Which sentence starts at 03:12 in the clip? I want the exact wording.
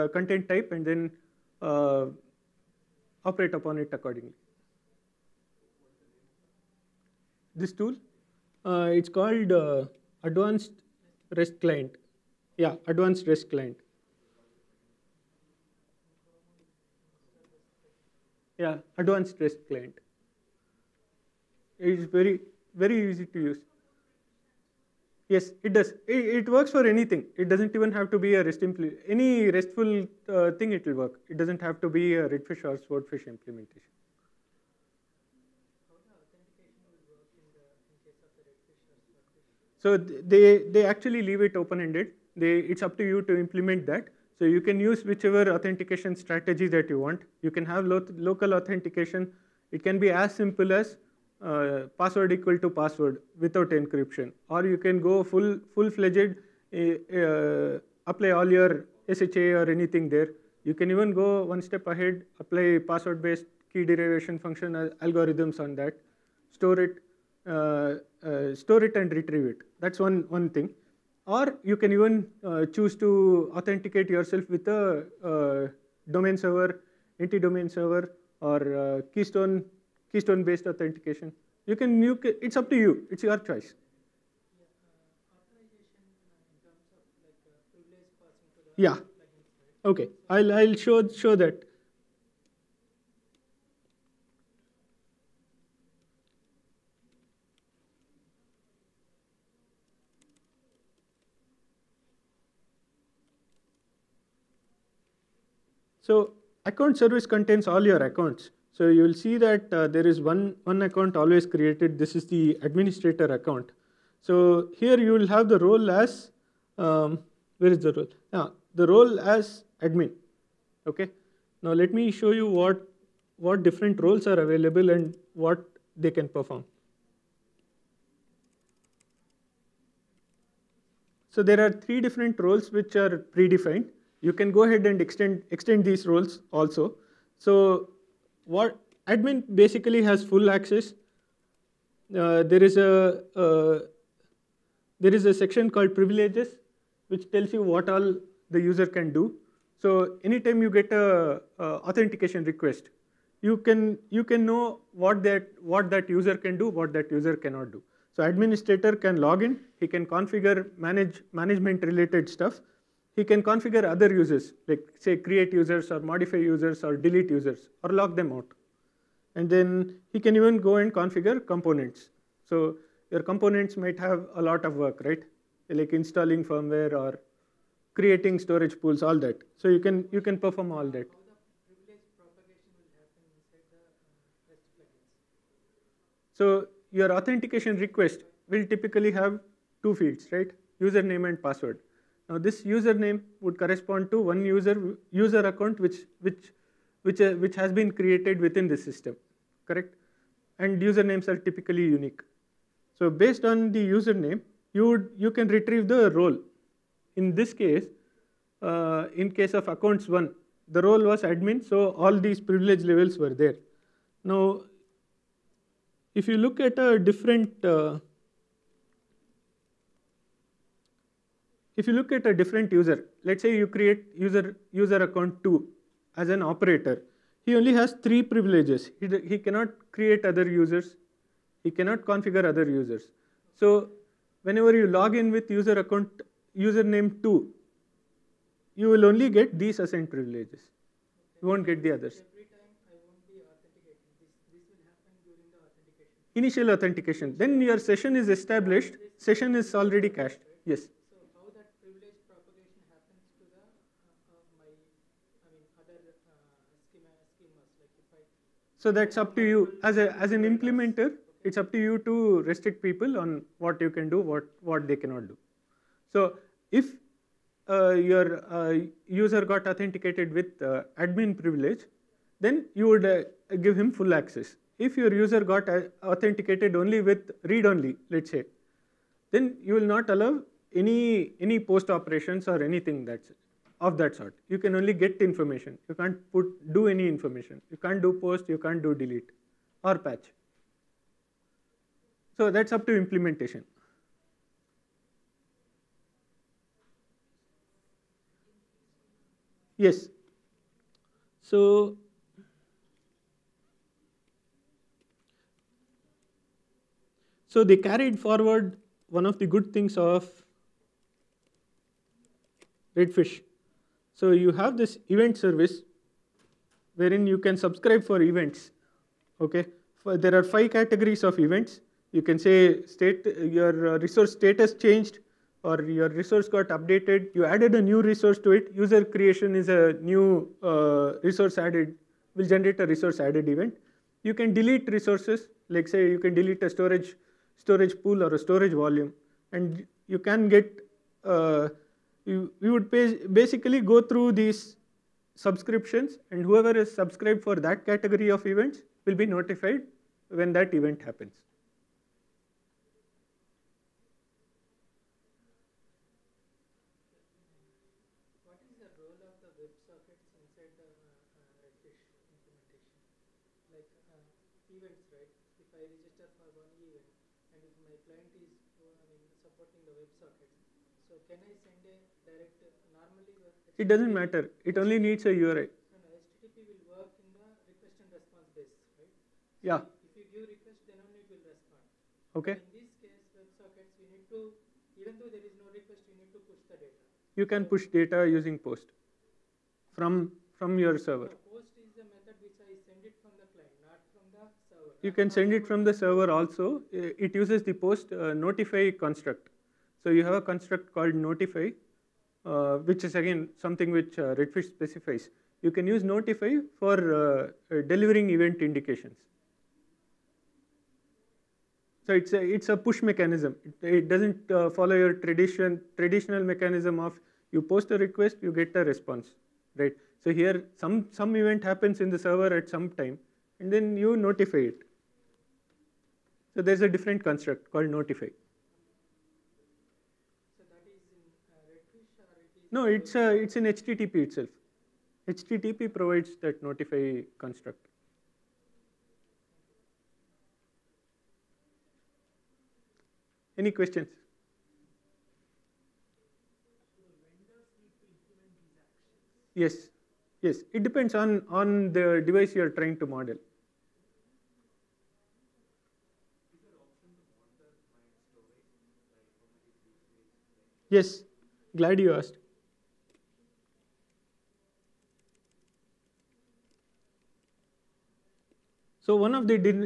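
Now this username would correspond to one user, user account which, which, which, uh, which has been created within this system, correct?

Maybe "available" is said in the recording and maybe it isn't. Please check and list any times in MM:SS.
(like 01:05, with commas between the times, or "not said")
02:04.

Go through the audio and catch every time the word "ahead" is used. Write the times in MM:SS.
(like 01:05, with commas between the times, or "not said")
01:01, 02:14.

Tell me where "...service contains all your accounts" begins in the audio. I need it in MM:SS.
01:46.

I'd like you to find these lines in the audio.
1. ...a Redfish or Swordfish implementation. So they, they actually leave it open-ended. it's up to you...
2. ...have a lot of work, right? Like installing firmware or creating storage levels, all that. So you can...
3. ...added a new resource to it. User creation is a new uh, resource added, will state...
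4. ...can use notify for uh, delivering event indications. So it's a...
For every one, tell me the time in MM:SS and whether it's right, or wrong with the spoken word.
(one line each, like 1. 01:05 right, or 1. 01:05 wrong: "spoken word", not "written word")
1. 00:32 right
2. 02:53 wrong: "pools", not "levels"
3. 05:27 wrong: "generate", not "state"
4. 06:45 right.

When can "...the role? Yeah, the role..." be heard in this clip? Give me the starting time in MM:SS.
01:57.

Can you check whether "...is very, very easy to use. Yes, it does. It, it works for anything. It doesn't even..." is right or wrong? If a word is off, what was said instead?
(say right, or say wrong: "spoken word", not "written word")
right.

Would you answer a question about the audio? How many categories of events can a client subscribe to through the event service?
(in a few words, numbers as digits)
5.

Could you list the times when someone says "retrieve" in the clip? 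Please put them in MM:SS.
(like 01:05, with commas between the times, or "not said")
01:09, 03:25.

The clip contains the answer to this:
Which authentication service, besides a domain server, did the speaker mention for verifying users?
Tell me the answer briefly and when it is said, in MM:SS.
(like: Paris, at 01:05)
Keystone, at 01:19.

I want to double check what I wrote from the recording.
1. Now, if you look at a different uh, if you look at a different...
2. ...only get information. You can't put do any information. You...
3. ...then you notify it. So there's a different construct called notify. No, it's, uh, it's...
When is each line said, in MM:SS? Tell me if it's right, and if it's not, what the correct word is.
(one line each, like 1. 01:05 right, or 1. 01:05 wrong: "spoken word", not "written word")
1. 03:34 right
2. 04:44 right
3. 07:03 right.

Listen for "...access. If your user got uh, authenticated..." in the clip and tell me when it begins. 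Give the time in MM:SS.
04:34.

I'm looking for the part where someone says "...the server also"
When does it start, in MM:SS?
06:35.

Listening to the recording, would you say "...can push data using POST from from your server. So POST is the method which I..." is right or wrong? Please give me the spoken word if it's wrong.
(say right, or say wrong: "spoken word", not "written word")
right.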